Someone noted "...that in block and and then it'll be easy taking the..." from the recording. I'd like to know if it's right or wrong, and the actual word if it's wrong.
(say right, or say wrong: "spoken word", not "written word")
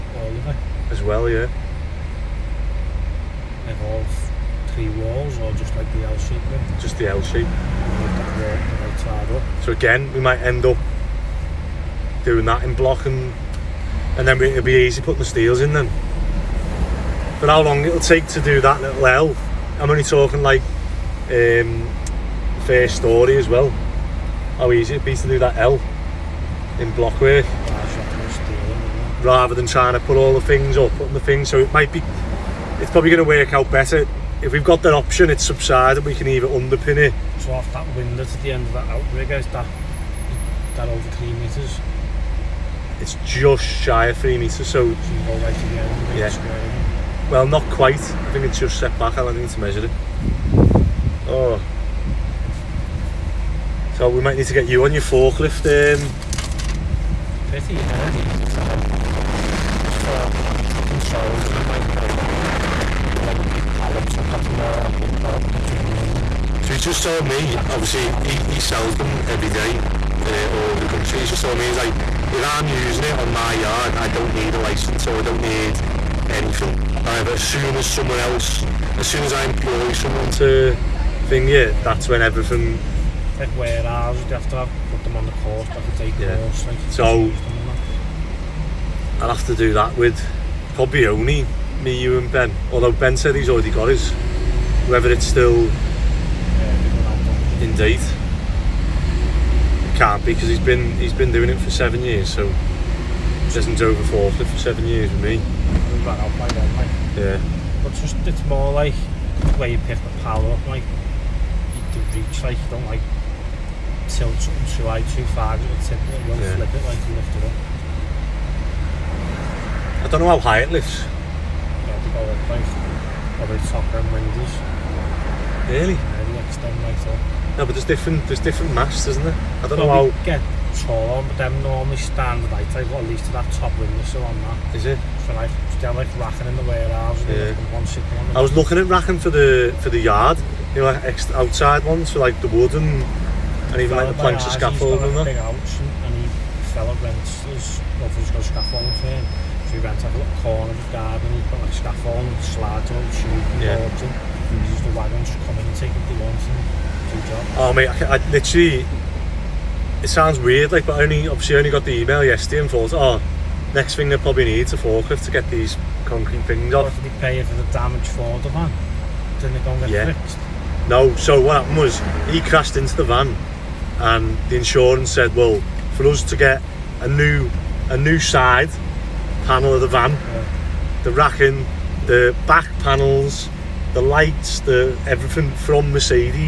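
wrong: "putting", not "taking".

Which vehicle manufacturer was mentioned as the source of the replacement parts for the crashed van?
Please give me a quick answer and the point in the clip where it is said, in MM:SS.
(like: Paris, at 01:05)
Mercedes, at 03:05.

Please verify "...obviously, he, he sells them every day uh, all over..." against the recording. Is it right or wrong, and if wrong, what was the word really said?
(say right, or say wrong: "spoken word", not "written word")
right.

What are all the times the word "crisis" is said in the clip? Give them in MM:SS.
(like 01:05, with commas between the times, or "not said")
not said.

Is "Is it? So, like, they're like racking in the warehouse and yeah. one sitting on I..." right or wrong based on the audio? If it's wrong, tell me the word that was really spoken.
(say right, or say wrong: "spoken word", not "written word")
right.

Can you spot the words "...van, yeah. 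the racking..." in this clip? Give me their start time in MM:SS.
02:59.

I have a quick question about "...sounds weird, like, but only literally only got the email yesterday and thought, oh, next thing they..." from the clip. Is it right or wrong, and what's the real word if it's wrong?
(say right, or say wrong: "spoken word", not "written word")
wrong: "obviously", not "literally".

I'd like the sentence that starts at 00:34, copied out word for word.
If we've got that option, it's subsided, we can either underpin it.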